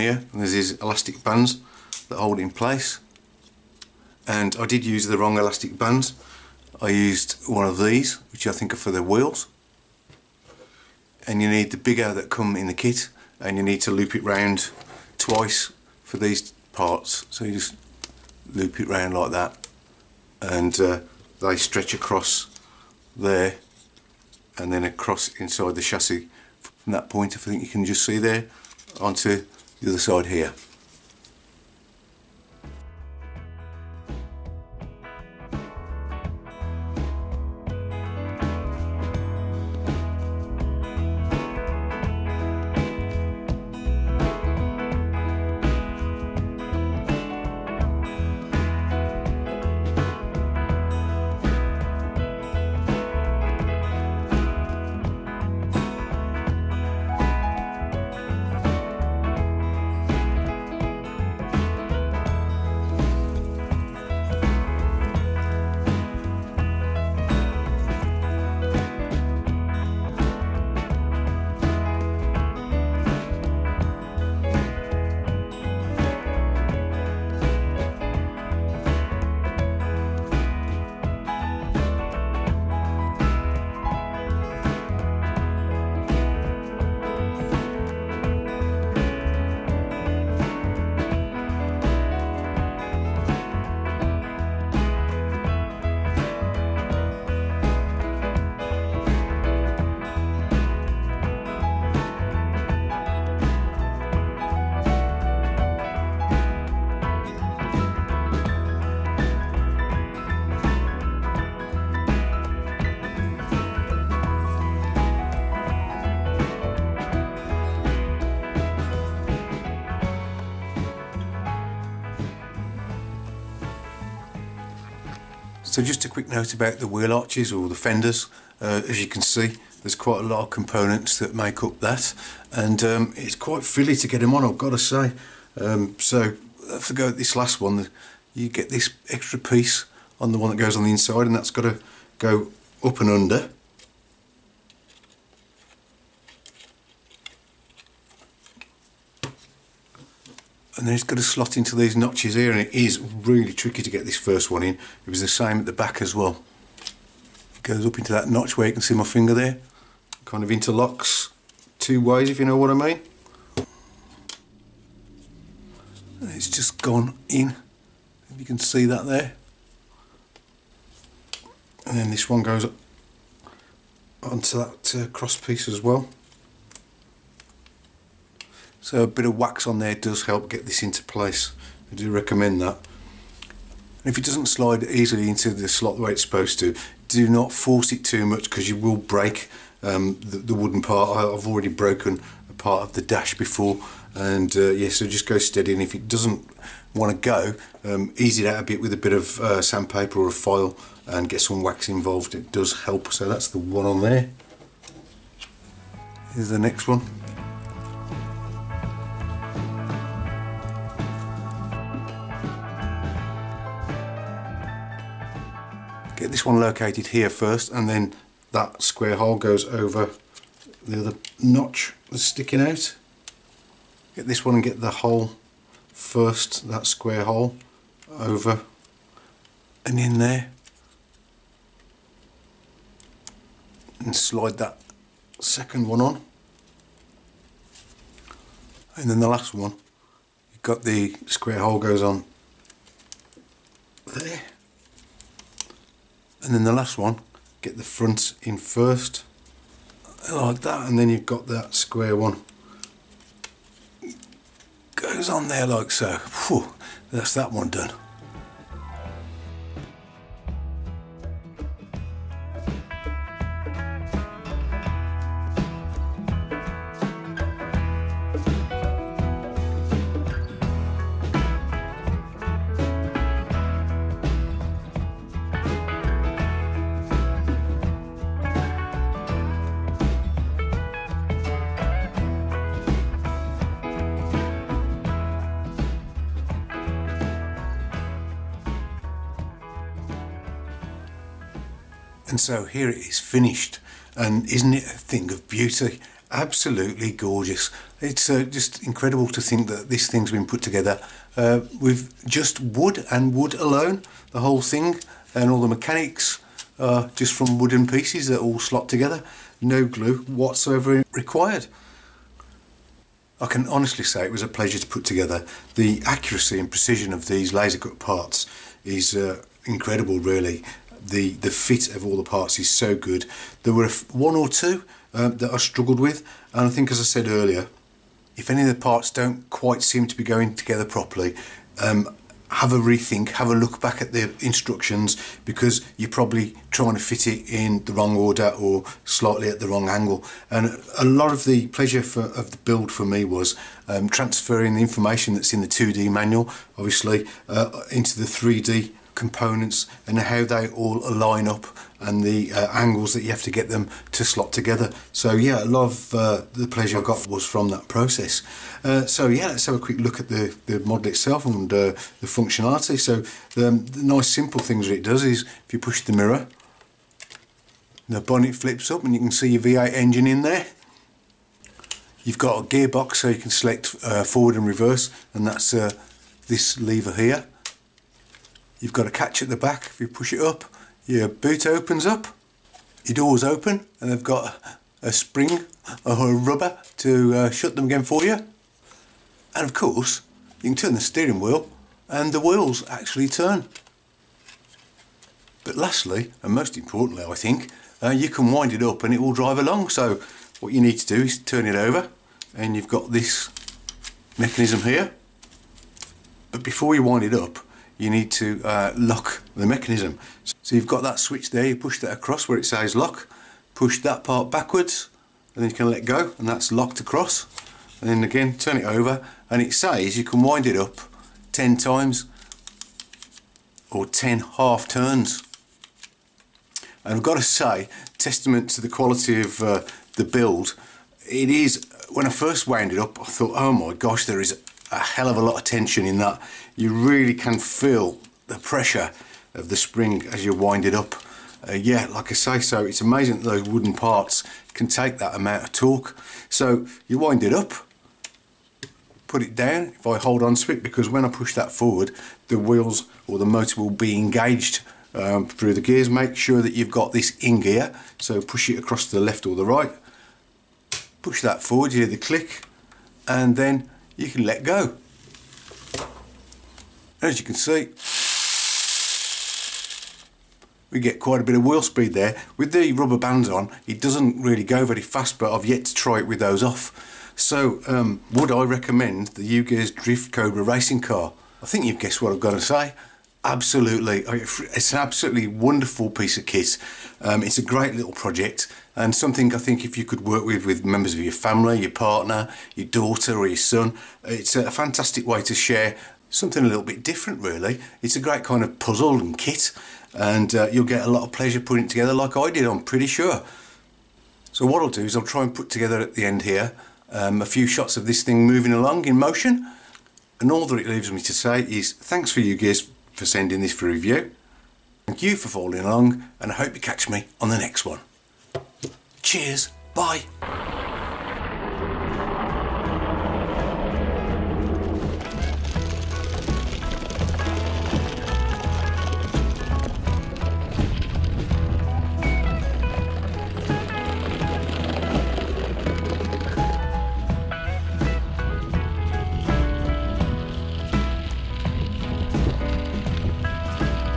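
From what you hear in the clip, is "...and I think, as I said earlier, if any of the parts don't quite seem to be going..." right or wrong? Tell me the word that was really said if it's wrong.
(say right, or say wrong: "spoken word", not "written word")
right.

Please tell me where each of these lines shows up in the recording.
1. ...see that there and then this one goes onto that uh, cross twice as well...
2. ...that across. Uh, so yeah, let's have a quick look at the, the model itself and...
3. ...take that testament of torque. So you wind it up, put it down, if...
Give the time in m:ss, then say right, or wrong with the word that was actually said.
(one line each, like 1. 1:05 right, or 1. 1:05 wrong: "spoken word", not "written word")
1. 2:48 wrong: "piece", not "twice"
2. 5:57 wrong: "process", not "across"
3. 7:24 wrong: "amount", not "testament".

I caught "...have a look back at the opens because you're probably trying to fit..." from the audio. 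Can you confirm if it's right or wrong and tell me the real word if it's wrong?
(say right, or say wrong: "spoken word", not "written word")
wrong: "instructions", not "opens".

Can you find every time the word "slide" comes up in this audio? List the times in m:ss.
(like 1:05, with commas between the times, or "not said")
3:04, 3:54.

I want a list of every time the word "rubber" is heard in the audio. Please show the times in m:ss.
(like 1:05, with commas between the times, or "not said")
6:26, 7:52.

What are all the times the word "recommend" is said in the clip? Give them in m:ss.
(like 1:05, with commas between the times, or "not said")
3:02, 7:58.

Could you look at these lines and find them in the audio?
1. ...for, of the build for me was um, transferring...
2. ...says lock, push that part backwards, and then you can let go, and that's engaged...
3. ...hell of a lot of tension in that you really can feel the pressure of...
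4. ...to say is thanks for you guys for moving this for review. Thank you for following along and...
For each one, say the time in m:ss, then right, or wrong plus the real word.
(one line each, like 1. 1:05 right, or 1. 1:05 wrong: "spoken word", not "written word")
1. 5:42 right
2. 6:52 wrong: "locked", not "engaged"
3. 7:14 right
4. 8:31 wrong: "sending", not "moving".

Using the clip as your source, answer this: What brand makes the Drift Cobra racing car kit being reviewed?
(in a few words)
UGEARS.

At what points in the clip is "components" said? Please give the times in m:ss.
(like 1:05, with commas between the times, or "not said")
2:10, 5:49.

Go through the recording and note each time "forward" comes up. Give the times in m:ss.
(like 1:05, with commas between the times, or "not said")
6:14, 7:31, 7:41.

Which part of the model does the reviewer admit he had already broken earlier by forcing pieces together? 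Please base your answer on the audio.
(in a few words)
the dash.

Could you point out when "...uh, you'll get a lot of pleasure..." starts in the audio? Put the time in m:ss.
8:20.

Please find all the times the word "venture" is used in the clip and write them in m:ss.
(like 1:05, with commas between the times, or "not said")
not said.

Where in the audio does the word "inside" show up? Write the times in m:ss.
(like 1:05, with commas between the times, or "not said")
0:25, 2:20.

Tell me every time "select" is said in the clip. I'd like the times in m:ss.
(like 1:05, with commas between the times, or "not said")
6:13.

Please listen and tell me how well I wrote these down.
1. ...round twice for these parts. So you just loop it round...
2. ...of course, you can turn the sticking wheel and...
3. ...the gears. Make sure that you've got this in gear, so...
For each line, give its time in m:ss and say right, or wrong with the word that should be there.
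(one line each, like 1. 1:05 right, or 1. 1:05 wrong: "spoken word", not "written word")
1. 0:14 right
2. 6:29 wrong: "steering", not "sticking"
3. 7:35 right.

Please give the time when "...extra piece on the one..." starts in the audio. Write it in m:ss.
2:19.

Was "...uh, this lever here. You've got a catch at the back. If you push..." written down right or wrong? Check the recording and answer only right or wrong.
right.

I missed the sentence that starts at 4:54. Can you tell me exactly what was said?
And isn't it a thing of beauty?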